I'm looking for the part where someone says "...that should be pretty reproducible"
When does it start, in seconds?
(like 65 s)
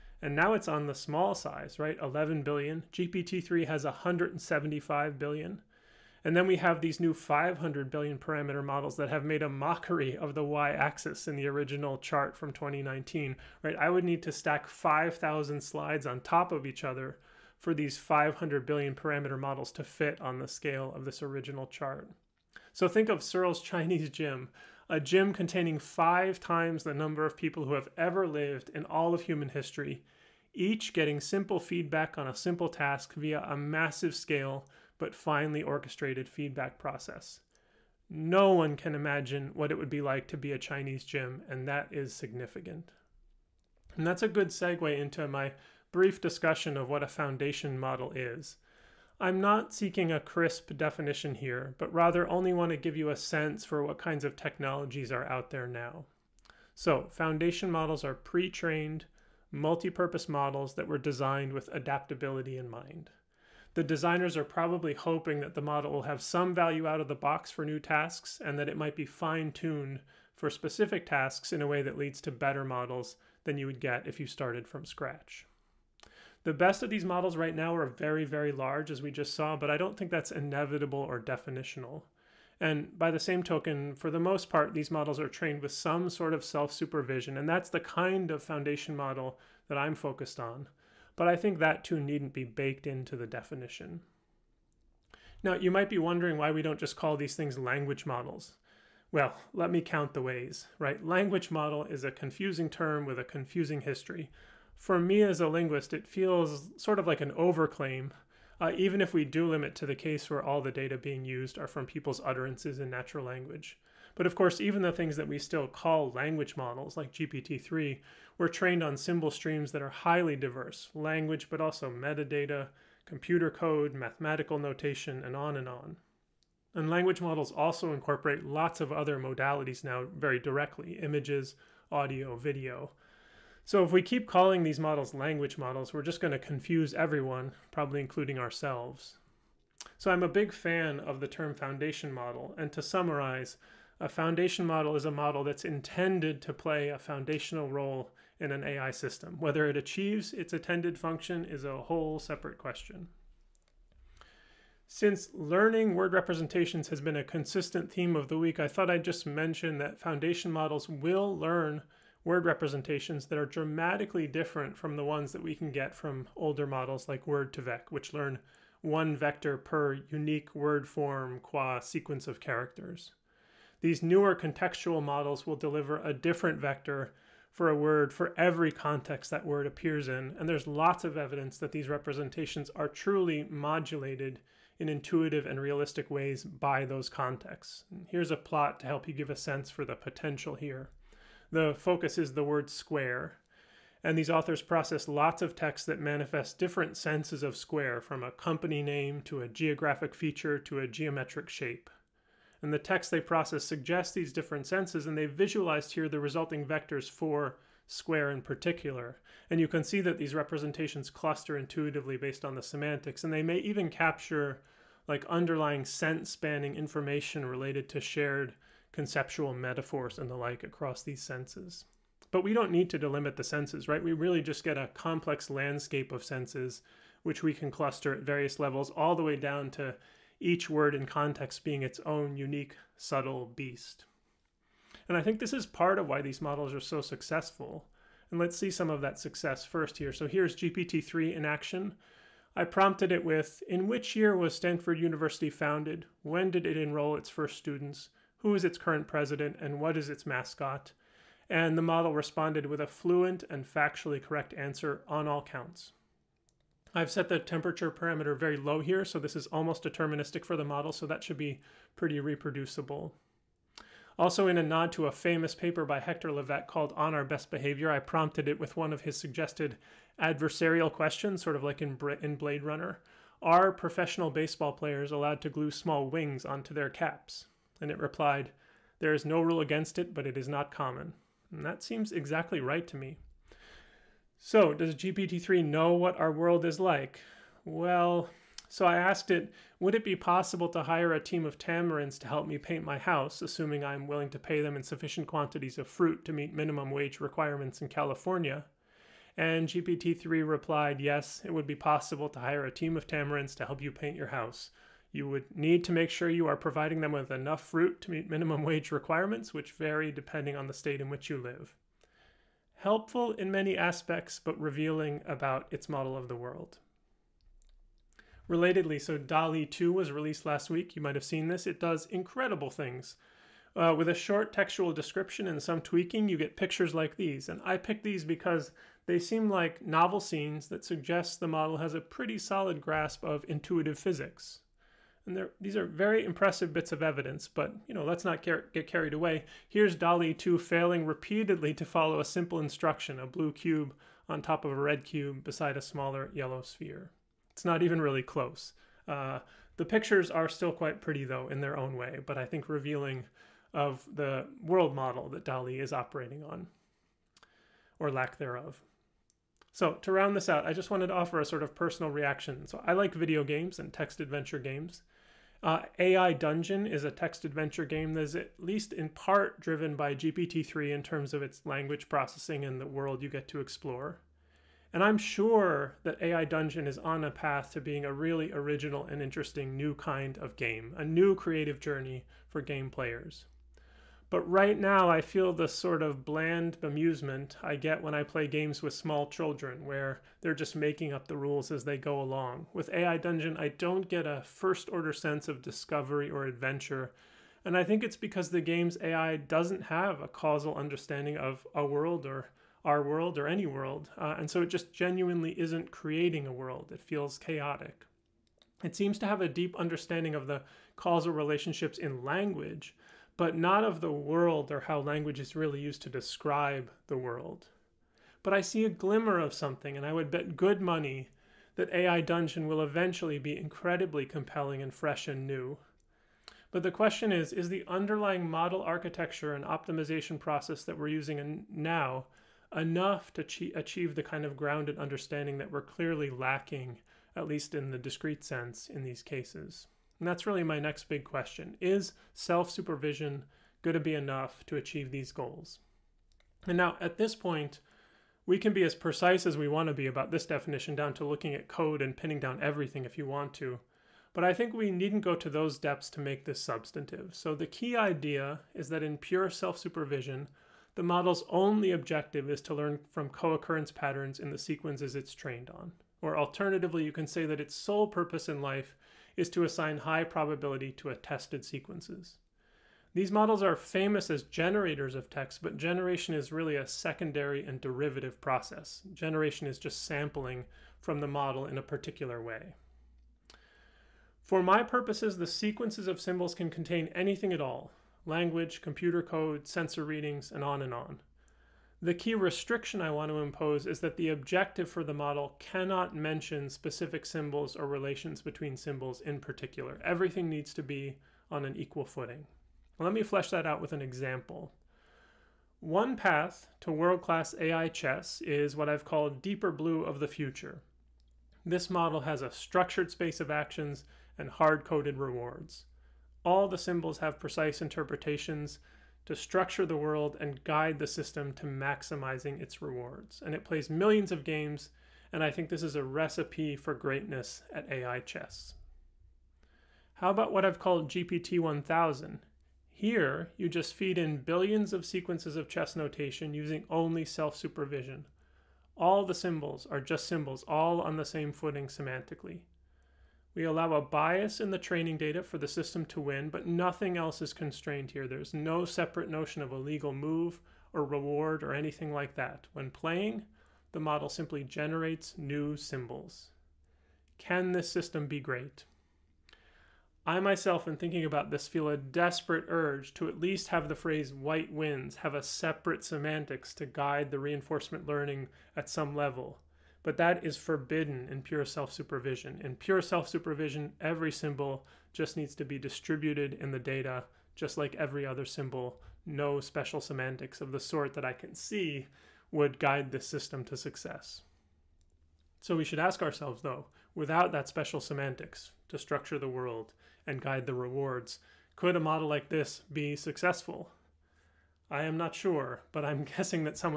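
261 s.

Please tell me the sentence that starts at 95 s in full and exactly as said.
Now, you might be wondering why we don't just call these things language models.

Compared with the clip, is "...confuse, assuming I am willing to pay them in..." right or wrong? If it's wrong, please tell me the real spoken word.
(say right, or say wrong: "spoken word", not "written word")
wrong: "house", not "confuse".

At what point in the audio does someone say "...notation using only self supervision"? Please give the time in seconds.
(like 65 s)
535 s.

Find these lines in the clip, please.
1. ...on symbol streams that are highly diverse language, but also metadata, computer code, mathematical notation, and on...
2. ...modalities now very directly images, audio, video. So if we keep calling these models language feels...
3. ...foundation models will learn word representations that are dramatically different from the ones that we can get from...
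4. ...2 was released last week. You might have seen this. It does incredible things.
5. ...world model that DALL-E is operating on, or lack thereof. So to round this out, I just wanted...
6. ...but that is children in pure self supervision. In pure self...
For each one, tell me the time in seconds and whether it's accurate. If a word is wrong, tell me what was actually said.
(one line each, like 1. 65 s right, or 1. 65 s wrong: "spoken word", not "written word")
1. 118 s right
2. 129 s wrong: "models", not "feels"
3. 159 s right
4. 319 s right
5. 354 s right
6. 570 s wrong: "forbidden", not "children".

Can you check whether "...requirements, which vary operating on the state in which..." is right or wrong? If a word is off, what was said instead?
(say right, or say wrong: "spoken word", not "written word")
wrong: "depending", not "operating".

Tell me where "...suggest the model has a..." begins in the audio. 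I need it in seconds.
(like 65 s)
330 s.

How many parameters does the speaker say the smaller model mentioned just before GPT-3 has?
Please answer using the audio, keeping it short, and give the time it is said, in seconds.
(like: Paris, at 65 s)
11 billion, at 2 s.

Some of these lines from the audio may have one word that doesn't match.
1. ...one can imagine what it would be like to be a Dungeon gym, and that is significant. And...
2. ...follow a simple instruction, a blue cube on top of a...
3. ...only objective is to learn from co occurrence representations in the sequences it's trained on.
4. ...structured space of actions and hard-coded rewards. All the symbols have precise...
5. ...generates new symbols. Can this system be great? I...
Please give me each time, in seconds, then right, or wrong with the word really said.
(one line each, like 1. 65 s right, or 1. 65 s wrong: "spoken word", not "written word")
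1. 38 s wrong: "Chinese", not "Dungeon"
2. 341 s right
3. 461 s wrong: "patterns", not "representations"
4. 512 s right
5. 554 s right.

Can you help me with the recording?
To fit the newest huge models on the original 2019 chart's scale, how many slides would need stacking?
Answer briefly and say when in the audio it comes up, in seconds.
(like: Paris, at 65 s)
5,000, at 14 s.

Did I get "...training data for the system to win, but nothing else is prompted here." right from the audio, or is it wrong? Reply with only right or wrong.
wrong.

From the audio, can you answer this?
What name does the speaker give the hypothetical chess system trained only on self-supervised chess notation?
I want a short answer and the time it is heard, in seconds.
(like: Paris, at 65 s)
GPT 1000, at 531 s.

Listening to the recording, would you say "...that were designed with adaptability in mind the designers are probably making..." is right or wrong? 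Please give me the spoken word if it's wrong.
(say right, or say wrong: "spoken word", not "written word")
wrong: "hoping", not "making".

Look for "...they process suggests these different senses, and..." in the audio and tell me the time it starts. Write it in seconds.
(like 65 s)
203 s.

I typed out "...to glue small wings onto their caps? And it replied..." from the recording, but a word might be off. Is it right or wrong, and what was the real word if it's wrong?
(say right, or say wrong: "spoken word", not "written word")
right.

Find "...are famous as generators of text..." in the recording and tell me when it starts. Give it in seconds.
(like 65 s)
473 s.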